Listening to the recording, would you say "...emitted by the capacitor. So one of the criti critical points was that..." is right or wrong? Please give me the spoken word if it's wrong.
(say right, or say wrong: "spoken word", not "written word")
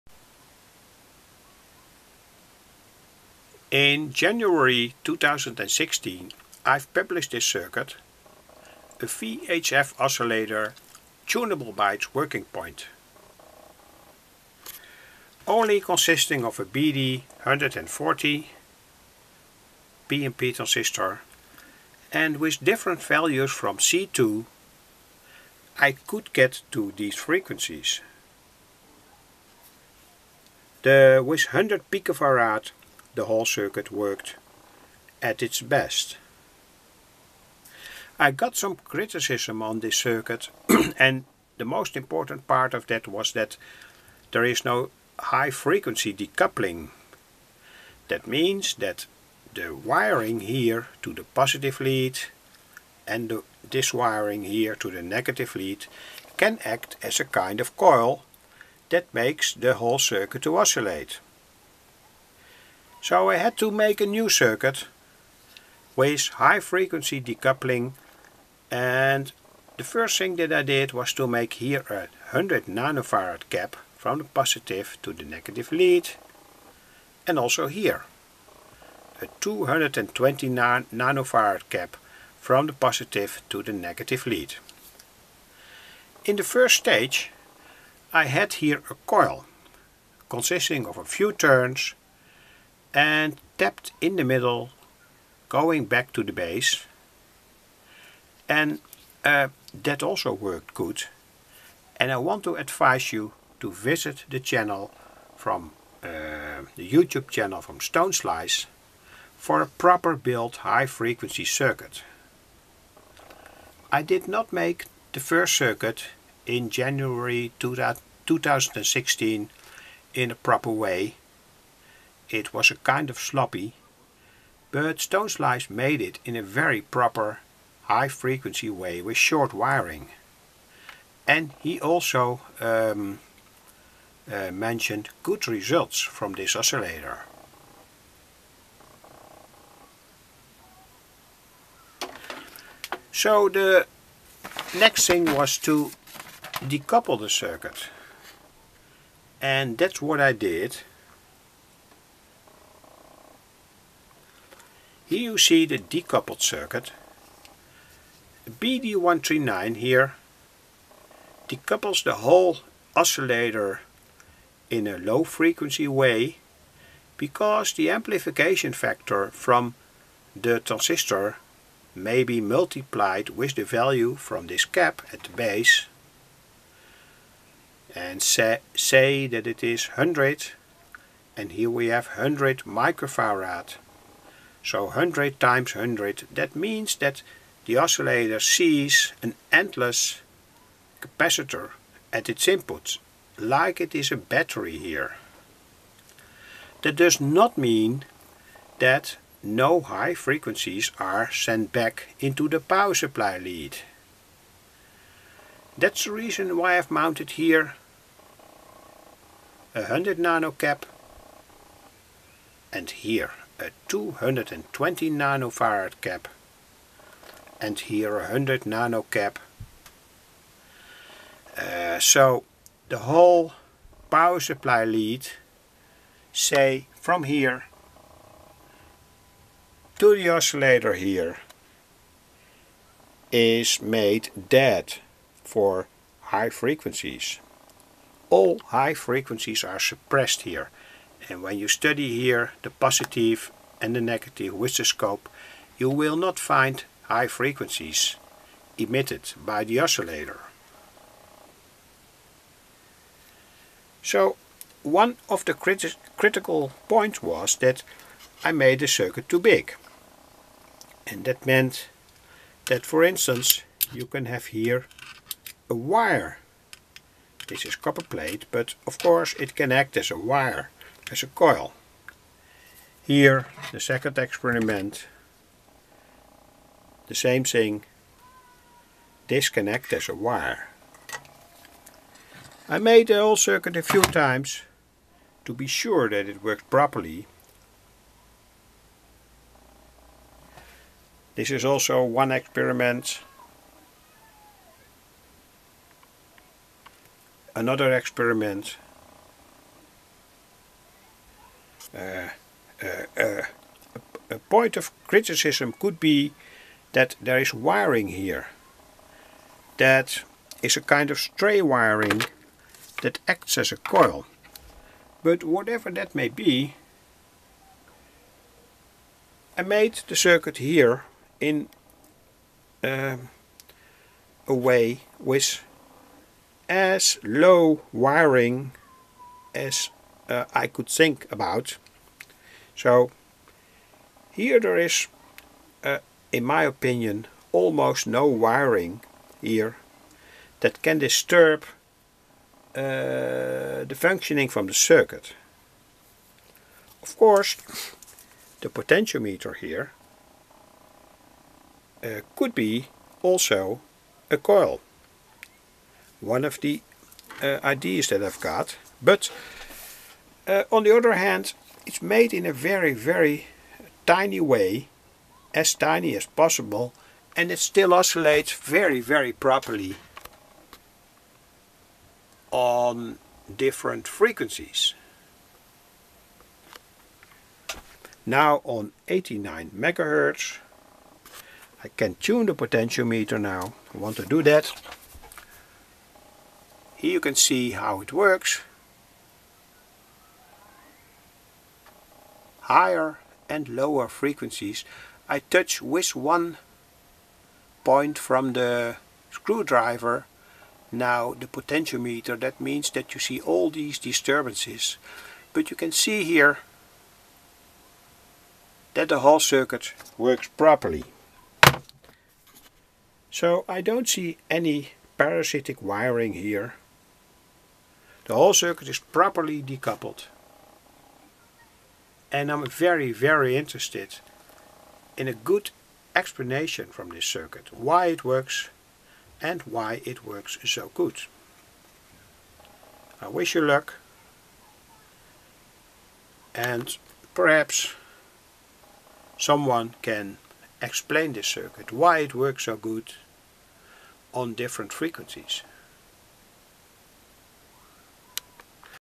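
wrong: "oscillator", not "capacitor".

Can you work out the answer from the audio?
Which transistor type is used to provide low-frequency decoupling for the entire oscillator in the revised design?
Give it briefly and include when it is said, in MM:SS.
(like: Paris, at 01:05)
BD139, at 02:38.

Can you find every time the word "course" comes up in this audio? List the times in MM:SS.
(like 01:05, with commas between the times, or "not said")
04:28, 05:47.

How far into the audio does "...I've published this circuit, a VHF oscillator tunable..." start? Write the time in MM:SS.
00:06.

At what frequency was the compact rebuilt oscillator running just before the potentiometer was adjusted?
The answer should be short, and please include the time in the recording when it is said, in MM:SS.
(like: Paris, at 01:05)
89 megahertz, at 06:19.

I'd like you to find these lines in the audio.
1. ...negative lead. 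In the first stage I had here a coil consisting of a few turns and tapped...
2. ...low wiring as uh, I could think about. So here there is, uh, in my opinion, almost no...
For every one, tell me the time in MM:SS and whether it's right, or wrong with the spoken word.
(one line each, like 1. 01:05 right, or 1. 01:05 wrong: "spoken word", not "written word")
1. 01:23 right
2. 05:27 right.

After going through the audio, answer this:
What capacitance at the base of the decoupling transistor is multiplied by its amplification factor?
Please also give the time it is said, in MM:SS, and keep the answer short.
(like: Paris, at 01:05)
100 microfarad, at 03:02.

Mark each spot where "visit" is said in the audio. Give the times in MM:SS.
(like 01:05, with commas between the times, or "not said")
01:43.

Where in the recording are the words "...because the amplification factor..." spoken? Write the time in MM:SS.
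02:47.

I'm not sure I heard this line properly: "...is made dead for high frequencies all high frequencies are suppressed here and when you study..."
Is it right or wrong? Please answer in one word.
right.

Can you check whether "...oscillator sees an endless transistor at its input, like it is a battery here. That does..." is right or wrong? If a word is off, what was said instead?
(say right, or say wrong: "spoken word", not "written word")
wrong: "capacitor", not "transistor".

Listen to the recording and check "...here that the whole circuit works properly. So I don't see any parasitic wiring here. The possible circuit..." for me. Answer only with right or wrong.
wrong.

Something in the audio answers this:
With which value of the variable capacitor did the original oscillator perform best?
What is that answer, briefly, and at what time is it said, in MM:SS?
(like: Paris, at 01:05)
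100 picofarad, at 00:31.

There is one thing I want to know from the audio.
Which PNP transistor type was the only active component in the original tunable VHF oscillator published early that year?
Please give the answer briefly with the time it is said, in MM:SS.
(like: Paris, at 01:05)
BD140, at 00:16.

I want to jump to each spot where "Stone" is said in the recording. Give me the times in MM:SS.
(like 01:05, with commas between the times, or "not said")
01:47, 02:04.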